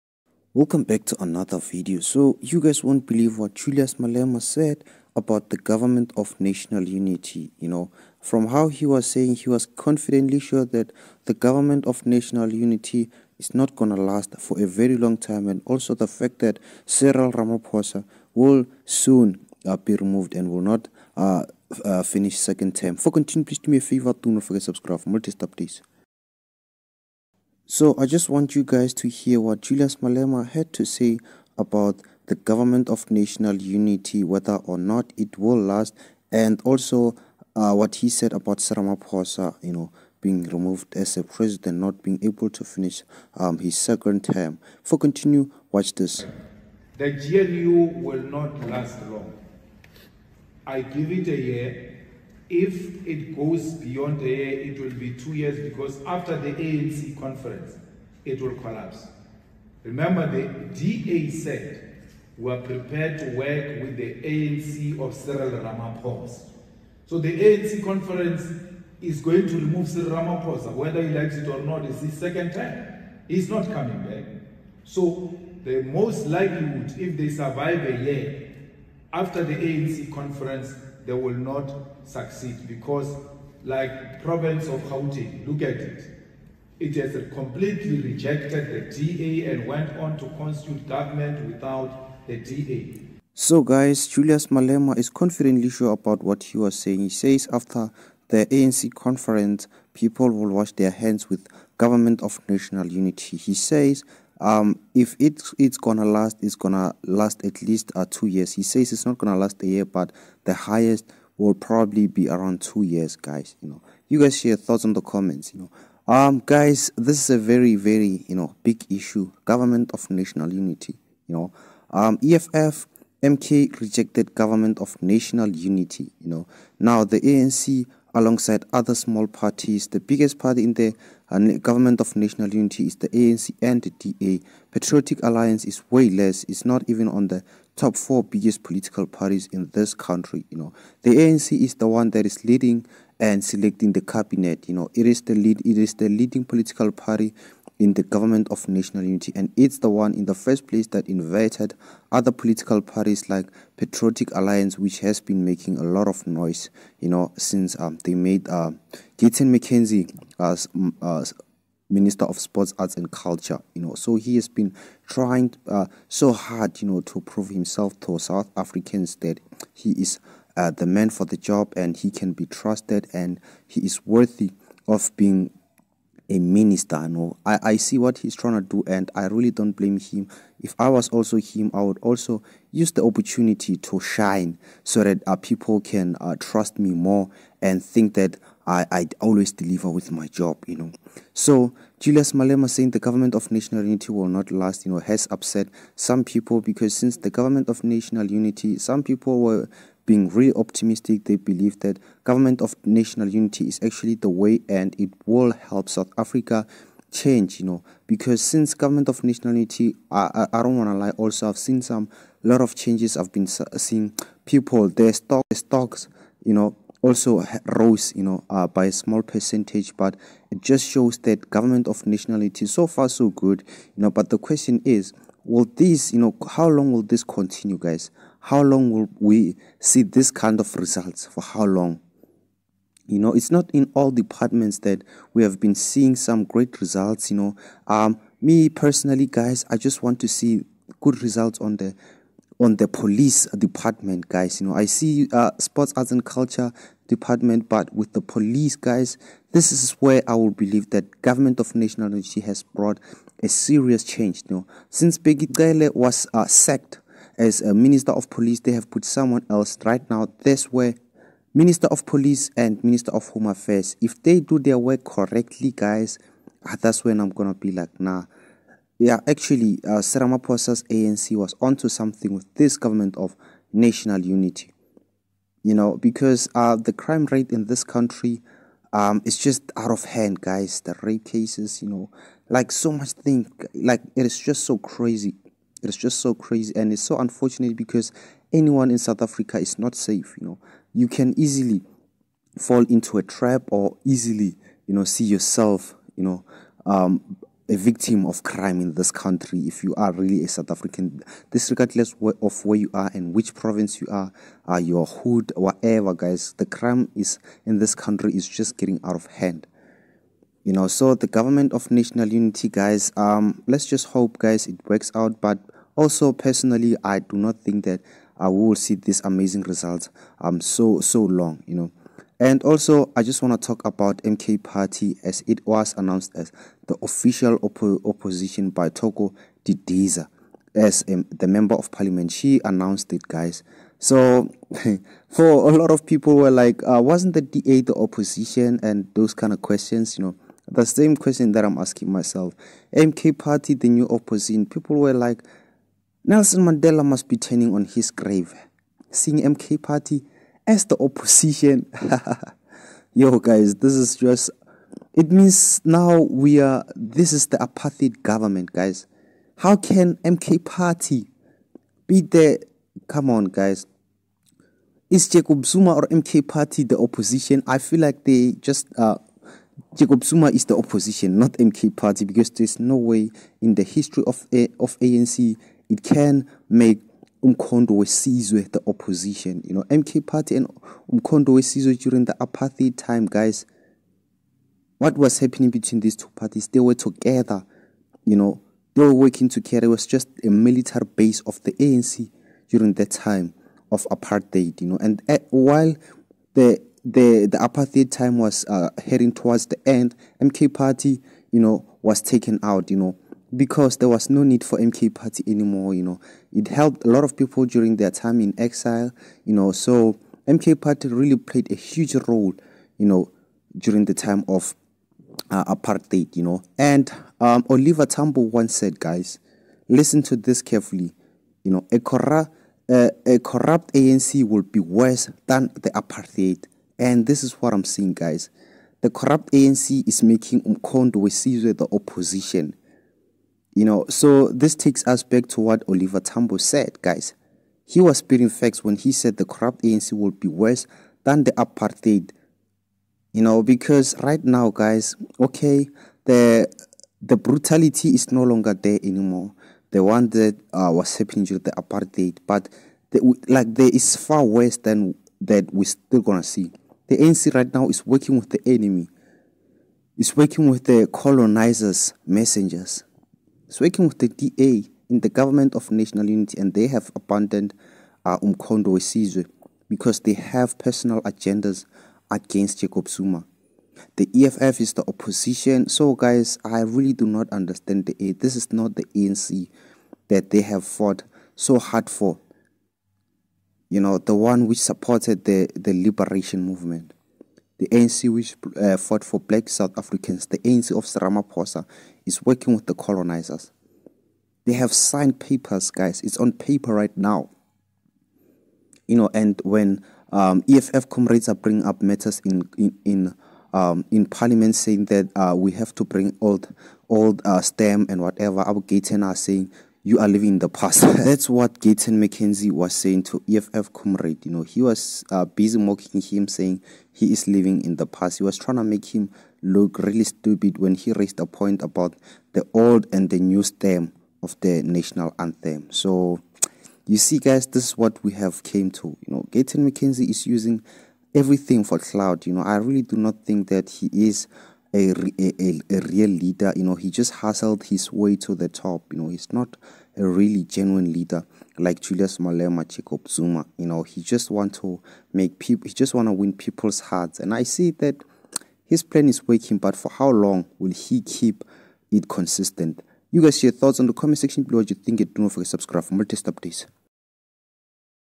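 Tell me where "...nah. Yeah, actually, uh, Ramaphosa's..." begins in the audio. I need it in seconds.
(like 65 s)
267 s.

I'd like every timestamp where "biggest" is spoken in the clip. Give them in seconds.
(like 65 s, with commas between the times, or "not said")
129 s, 138 s.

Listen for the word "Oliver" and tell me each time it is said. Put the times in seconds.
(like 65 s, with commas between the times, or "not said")
417 s, 435 s.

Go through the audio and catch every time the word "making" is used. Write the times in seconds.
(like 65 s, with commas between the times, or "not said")
155 s, 430 s.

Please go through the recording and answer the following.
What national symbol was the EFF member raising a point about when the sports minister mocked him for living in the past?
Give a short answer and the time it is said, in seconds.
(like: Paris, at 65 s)
national anthem, at 524 s.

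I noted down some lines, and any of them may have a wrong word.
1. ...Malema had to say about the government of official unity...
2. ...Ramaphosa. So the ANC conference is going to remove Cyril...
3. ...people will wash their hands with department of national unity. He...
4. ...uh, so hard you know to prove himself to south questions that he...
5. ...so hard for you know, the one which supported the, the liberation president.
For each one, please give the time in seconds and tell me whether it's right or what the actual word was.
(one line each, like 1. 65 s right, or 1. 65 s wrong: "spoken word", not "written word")
1. 29 s wrong: "national", not "official"
2. 65 s right
3. 99 s wrong: "government", not "department"
4. 165 s wrong: "africans", not "questions"
5. 481 s wrong: "movement", not "president".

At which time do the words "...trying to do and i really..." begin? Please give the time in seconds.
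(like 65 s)
178 s.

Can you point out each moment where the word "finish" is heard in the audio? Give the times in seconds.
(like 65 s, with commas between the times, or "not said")
22 s, 42 s.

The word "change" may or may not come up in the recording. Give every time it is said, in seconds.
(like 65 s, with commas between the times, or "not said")
207 s, 212 s, 254 s.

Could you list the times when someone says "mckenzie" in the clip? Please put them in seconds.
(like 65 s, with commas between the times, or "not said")
159 s, 512 s, 529 s.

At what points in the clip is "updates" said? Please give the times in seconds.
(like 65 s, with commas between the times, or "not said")
556 s.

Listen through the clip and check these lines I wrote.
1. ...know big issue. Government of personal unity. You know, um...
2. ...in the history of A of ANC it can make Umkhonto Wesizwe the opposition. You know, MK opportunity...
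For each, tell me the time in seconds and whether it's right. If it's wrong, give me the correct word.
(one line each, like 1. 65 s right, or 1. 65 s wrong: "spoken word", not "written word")
1. 118 s wrong: "national", not "personal"
2. 373 s wrong: "party", not "opportunity".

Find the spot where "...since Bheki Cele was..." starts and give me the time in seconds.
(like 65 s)
254 s.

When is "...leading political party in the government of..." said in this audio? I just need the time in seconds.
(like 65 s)
146 s.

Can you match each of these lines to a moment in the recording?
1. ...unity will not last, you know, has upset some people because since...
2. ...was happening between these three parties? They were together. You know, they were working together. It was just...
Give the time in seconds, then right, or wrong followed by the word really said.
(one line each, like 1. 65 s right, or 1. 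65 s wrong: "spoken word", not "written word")
1. 193 s right
2. 385 s wrong: "two", not "three".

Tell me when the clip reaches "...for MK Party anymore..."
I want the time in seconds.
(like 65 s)
404 s.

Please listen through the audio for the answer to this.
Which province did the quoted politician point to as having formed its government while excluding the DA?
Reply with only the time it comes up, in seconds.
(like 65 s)
84 s.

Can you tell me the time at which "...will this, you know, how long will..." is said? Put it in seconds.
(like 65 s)
225 s.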